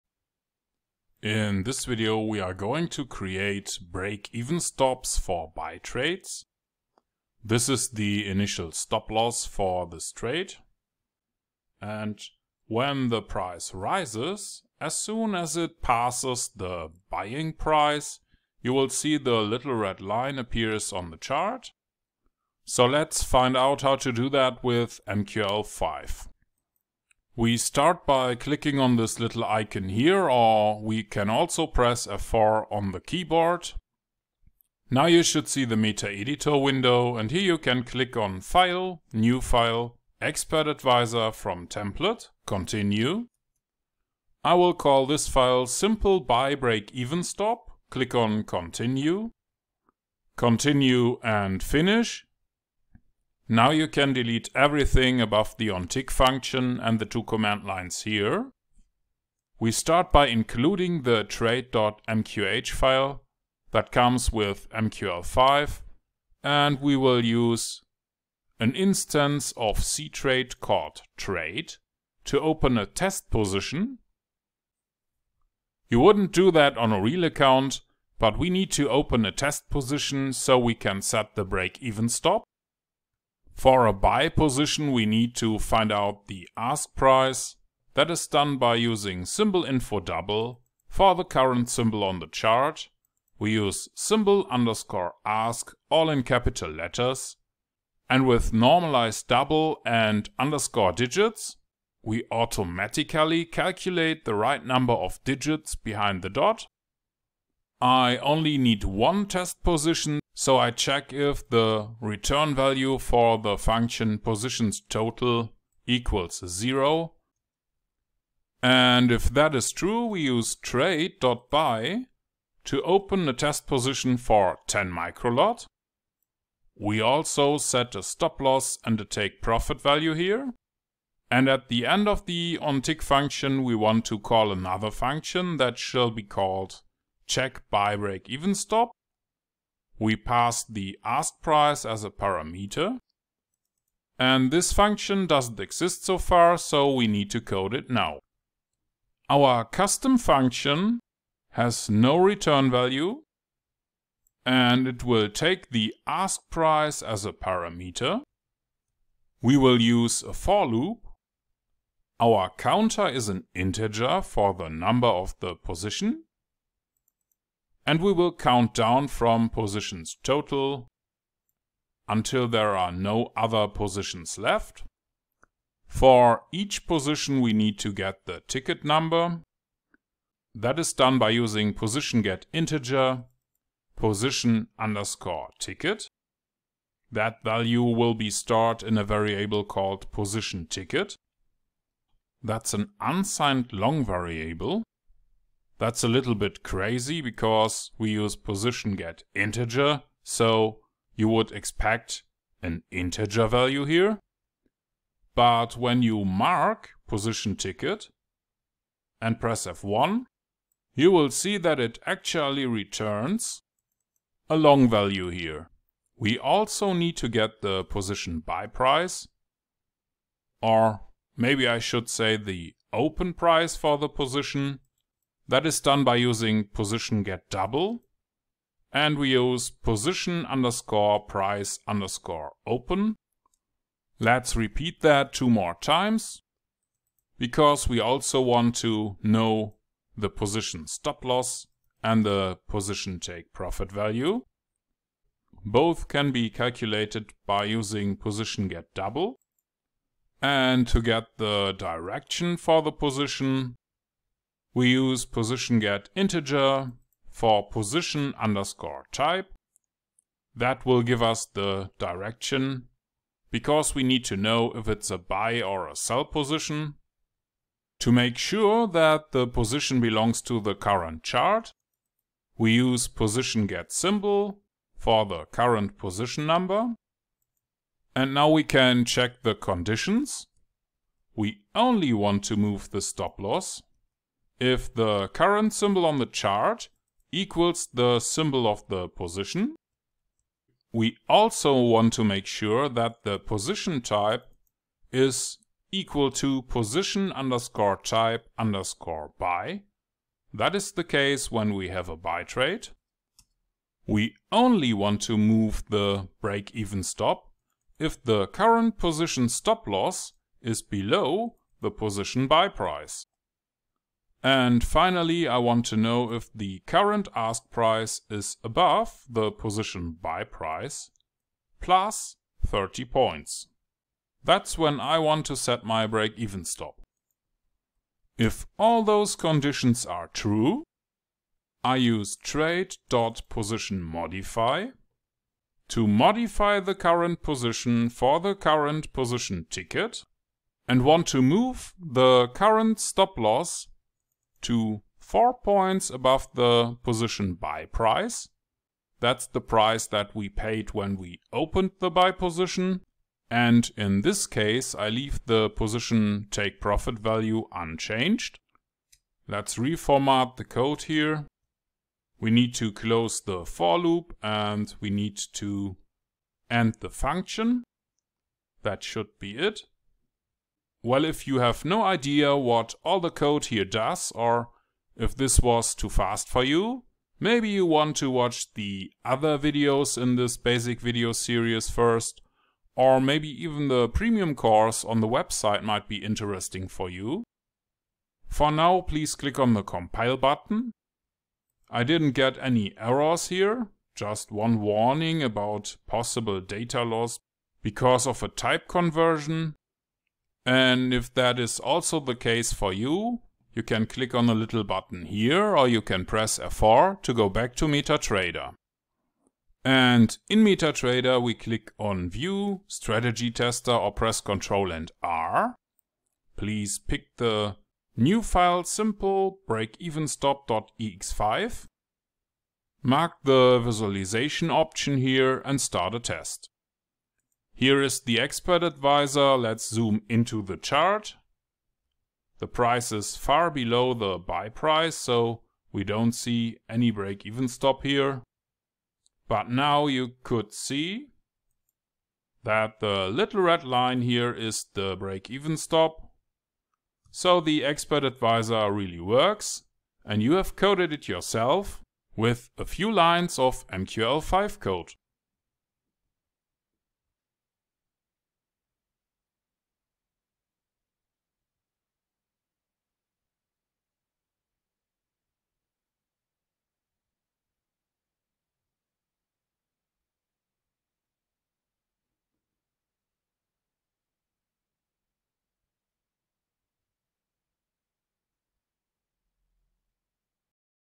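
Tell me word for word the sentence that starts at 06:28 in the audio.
For now, please click on the compile button.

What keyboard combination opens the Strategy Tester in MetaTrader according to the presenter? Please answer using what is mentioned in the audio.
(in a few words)
Ctrl and R.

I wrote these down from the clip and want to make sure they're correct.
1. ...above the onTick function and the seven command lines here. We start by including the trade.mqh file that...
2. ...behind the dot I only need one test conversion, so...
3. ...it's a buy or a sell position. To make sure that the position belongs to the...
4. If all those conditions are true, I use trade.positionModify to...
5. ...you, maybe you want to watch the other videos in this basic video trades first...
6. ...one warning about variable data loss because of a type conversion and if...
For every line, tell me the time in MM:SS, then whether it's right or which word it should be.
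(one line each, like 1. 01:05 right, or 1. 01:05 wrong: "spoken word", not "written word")
1. 00:55 wrong: "two", not "seven"
2. 01:45 wrong: "position", not "conversion"
3. 04:24 right
4. 05:28 right
5. 06:16 wrong: "series", not "trades"
6. 06:34 wrong: "possible", not "variable".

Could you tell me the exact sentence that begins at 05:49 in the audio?
That's the price that we paid when we opened the buy position.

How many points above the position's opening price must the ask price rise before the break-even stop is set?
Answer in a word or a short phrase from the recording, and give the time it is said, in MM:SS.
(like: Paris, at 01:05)
30 points, at 05:22.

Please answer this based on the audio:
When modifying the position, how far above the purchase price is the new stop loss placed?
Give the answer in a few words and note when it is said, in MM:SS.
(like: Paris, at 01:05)
4 points, at 05:45.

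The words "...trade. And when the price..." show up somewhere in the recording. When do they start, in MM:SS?
00:10.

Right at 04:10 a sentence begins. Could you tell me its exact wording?
And to get the direction for the position, we use position get integer for position underscore type.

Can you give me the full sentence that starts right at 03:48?
And we use position underscore price underscore open.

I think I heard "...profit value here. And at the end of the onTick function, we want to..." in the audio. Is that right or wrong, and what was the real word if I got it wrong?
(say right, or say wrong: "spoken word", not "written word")
right.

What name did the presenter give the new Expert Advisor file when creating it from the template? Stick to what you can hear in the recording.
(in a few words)
Simple Buy Break Even Stop.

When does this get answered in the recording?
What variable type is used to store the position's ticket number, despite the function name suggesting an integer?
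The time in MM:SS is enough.
03:13.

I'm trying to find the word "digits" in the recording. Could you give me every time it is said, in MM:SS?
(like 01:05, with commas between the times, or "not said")
01:40, 01:45.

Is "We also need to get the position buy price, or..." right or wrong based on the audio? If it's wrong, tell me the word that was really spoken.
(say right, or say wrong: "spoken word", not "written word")
right.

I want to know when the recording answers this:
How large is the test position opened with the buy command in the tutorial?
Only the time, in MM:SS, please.
02:04.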